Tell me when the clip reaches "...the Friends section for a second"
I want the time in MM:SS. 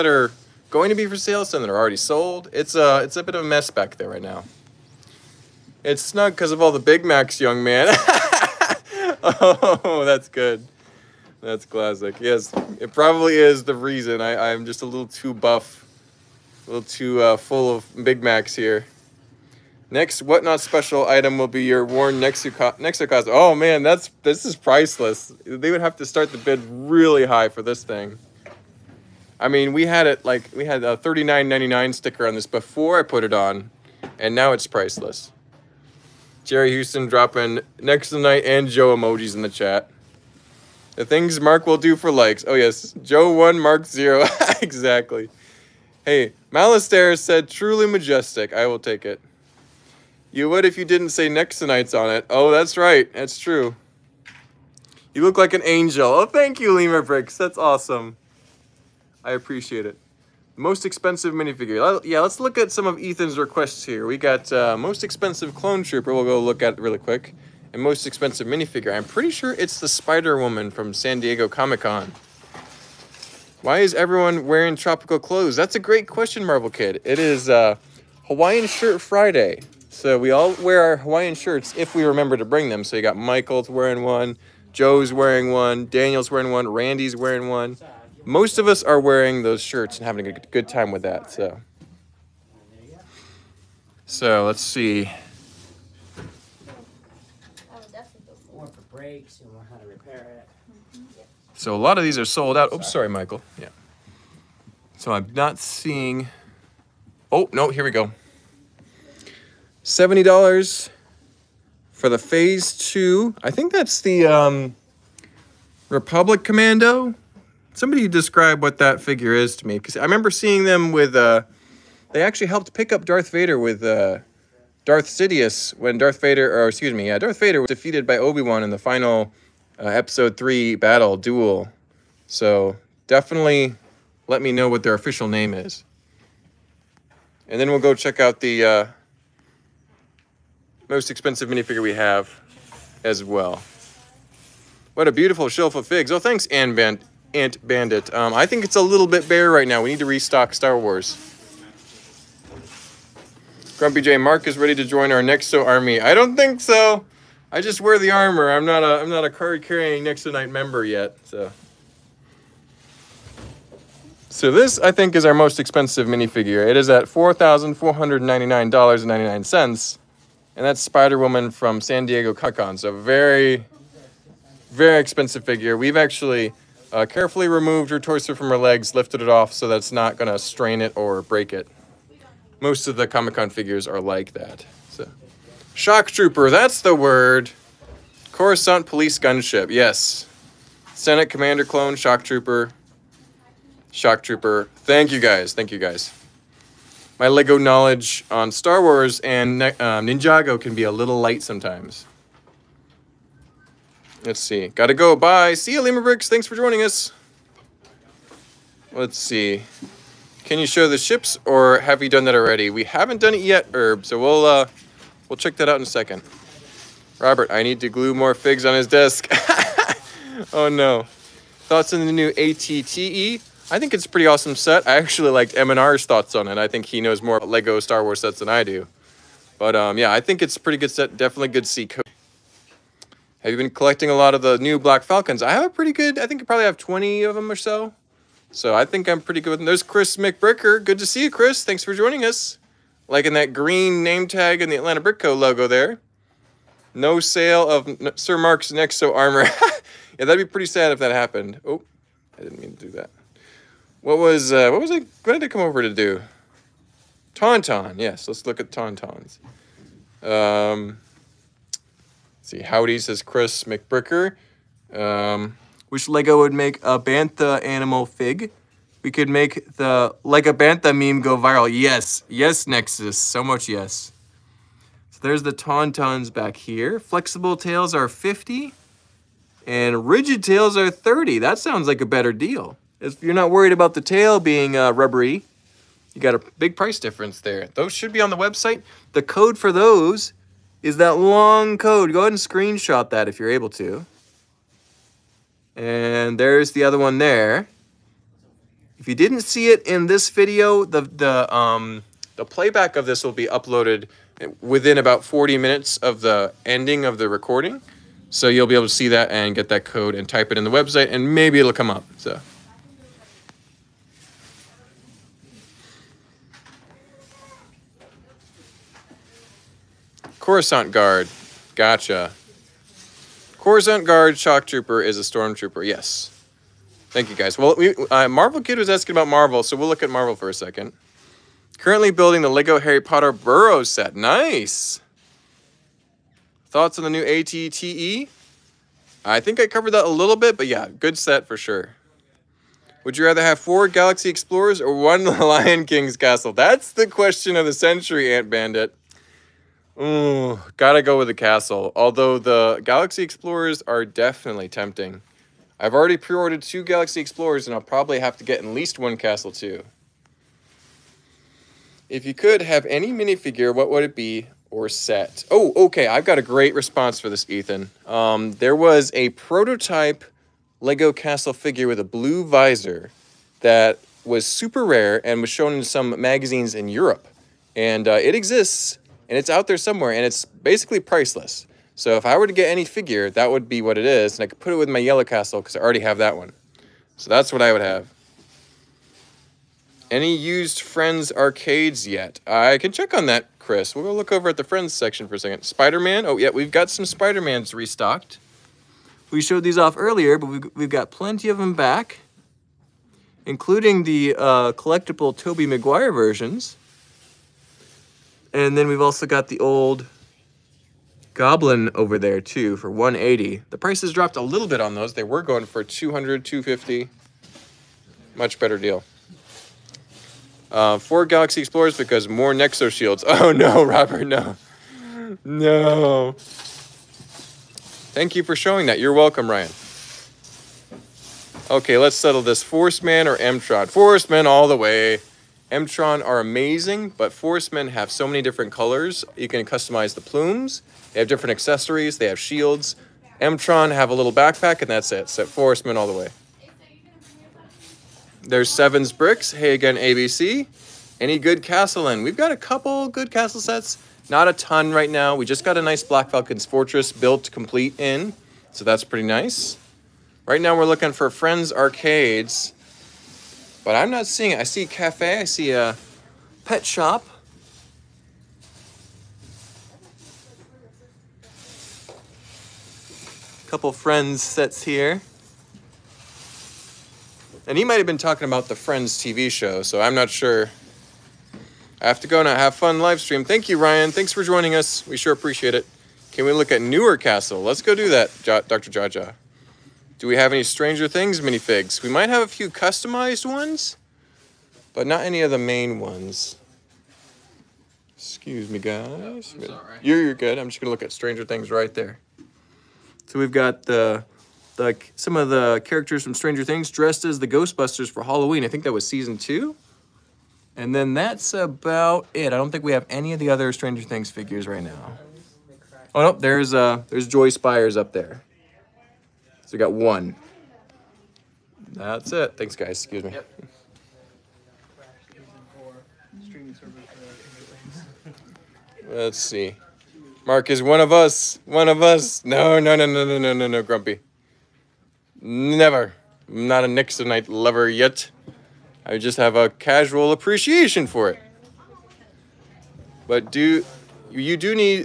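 06:34.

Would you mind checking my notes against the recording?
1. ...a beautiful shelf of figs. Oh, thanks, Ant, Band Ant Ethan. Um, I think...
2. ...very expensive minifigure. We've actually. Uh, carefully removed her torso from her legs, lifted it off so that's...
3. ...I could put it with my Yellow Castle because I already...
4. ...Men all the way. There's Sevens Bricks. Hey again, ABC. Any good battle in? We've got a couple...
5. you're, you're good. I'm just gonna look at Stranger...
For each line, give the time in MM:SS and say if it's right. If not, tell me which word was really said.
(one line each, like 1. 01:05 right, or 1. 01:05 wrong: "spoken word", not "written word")
1. 02:25 wrong: "Bandit", not "Ethan"
2. 02:54 wrong: "figure", not "minifigure"
3. 06:24 right
4. 07:25 wrong: "castle", not "battle"
5. 08:20 right.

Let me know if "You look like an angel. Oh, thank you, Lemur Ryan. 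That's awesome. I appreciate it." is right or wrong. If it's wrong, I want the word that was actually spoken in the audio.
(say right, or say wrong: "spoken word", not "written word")
wrong: "Bricks", not "Ryan".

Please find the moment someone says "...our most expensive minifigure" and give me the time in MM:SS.
02:45.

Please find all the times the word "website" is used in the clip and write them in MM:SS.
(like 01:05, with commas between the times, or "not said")
04:48, 05:10.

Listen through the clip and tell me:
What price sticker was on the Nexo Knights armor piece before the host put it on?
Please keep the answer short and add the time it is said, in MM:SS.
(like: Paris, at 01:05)
$39.99, at 00:30.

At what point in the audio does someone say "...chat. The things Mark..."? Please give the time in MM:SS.
00:39.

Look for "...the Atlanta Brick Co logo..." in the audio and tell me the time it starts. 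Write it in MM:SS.
04:04.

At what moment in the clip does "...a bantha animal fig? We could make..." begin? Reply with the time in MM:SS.
04:26.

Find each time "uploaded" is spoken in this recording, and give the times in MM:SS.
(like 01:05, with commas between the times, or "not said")
05:03.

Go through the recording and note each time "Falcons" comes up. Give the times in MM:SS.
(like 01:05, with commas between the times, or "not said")
03:55, 07:36.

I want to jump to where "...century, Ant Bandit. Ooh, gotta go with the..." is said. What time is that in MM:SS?
05:47.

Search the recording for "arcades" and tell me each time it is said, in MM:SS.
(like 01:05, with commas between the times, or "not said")
06:31, 07:41.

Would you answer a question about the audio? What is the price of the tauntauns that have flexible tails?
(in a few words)
$50.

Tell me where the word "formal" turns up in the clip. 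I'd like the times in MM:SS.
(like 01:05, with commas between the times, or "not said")
not said.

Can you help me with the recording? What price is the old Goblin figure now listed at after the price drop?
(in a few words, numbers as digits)
$180.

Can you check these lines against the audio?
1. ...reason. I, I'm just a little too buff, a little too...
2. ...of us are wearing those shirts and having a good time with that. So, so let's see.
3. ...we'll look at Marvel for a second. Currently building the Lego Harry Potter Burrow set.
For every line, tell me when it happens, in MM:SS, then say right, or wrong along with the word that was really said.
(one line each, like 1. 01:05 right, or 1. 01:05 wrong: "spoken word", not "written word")
1. 00:13 right
2. 01:28 right
3. 05:29 right.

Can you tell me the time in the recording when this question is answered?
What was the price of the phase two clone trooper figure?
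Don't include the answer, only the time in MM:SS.
01:49.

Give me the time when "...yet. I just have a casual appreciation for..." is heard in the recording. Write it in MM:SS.
08:57.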